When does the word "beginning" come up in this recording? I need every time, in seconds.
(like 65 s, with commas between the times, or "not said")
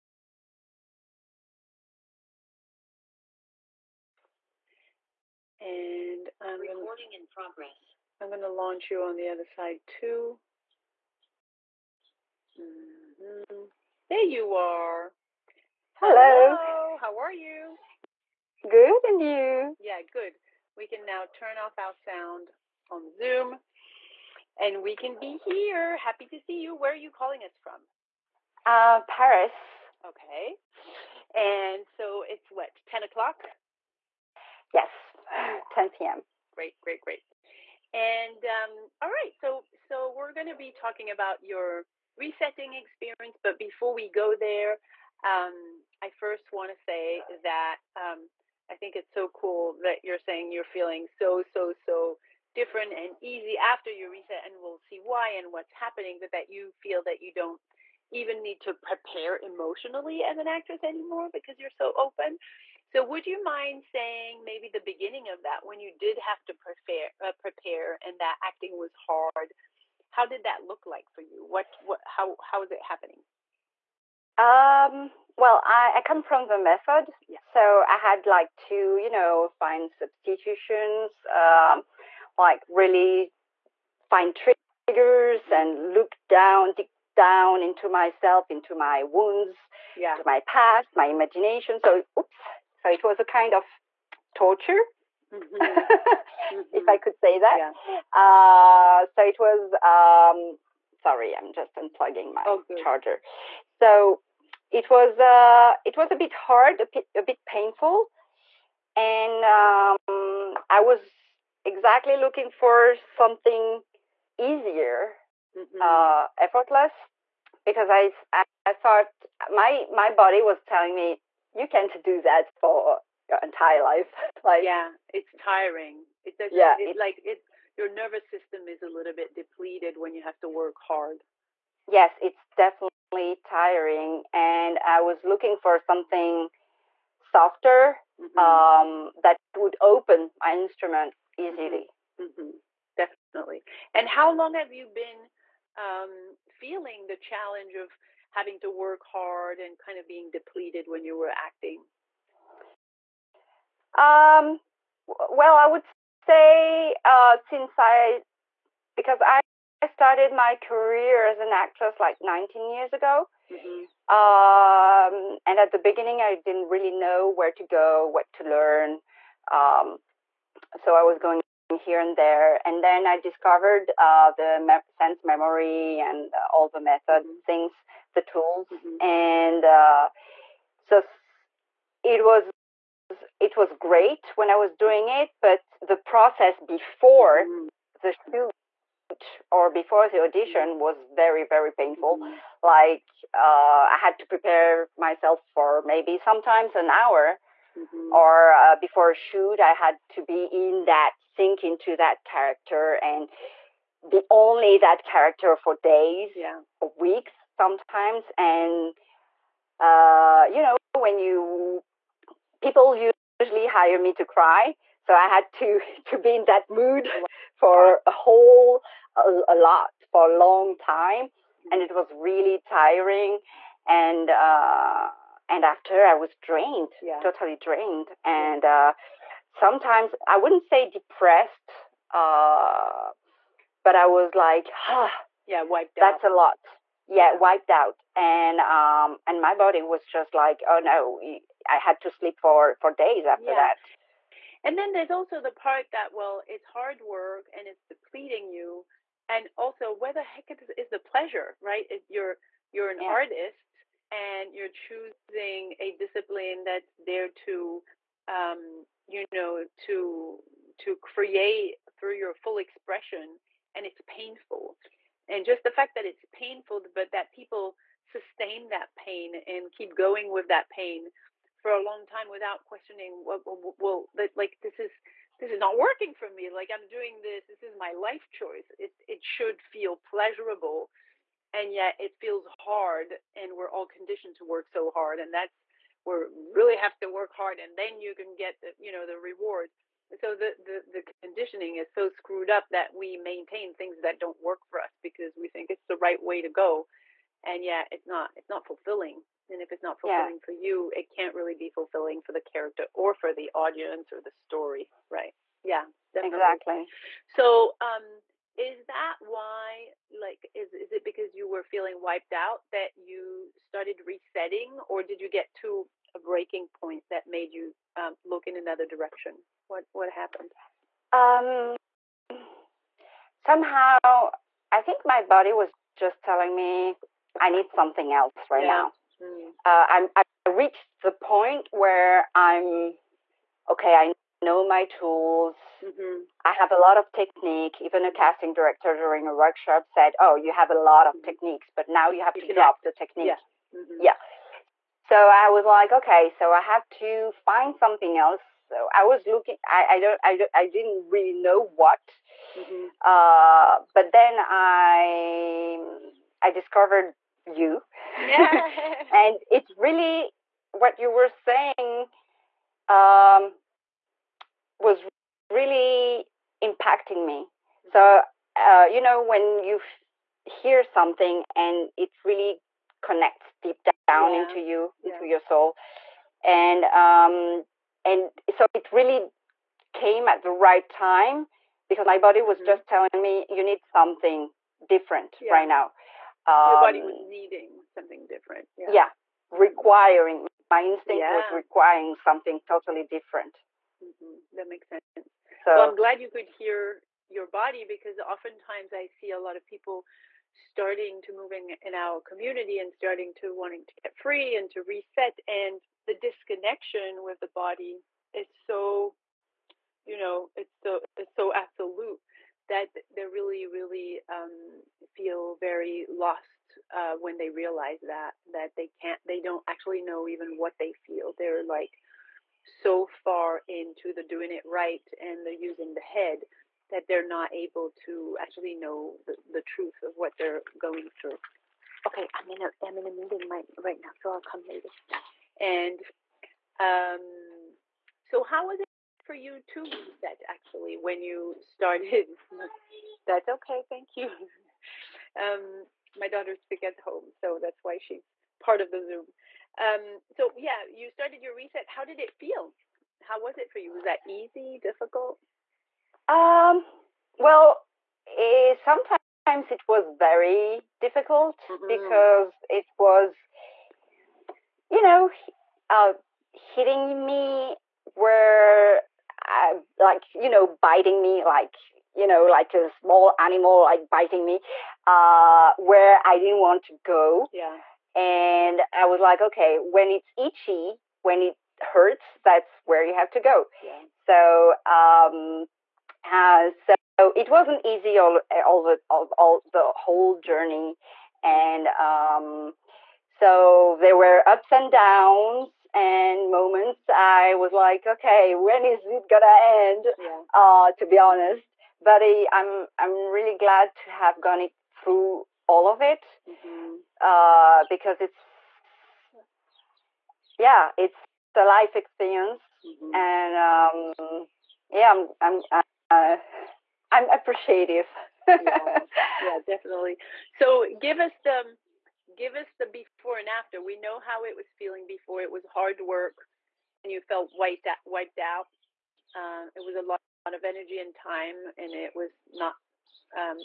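64 s, 165 s.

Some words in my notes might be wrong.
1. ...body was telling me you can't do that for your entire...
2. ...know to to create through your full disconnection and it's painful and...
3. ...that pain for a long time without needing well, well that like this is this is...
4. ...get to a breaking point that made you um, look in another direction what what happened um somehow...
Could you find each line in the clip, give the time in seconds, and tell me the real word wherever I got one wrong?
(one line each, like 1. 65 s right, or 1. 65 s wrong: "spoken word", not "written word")
1. 120 s right
2. 259 s wrong: "expression", not "disconnection"
3. 270 s wrong: "questioning", not "needing"
4. 315 s right.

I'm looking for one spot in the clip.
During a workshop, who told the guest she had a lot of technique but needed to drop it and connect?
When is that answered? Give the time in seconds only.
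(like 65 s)
338 s.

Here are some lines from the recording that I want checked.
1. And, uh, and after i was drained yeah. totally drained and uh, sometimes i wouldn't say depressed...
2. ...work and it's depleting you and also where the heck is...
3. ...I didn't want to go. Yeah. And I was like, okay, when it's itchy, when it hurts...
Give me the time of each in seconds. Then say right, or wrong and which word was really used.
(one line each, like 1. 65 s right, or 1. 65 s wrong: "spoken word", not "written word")
1. 223 s right
2. 247 s right
3. 476 s right.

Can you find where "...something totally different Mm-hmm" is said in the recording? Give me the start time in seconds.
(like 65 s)
392 s.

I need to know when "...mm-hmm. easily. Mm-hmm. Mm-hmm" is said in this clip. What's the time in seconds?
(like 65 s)
141 s.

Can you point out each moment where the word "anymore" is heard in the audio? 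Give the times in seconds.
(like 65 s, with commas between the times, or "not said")
60 s.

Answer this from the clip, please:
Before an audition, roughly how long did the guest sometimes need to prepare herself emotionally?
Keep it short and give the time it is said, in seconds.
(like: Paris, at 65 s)
An hour, at 196 s.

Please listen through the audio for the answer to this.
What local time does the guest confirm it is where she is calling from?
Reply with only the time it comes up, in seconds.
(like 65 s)
35 s.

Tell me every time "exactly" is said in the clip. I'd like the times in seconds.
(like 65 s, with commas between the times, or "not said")
111 s, 306 s.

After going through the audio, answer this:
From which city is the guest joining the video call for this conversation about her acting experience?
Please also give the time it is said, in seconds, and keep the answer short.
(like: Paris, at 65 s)
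Paris, at 29 s.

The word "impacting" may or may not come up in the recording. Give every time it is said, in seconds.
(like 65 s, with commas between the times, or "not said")
366 s.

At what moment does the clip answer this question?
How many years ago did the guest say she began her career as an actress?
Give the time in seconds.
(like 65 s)
162 s.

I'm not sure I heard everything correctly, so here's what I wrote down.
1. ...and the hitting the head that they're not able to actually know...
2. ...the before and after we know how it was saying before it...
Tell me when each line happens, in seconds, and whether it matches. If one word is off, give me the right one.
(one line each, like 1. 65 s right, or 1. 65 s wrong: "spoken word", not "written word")
1. 425 s wrong: "using", not "hitting"
2. 522 s wrong: "feeling", not "saying".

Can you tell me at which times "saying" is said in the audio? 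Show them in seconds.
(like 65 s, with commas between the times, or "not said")
50 s, 63 s, 361 s.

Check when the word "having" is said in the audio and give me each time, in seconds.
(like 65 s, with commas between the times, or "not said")
148 s.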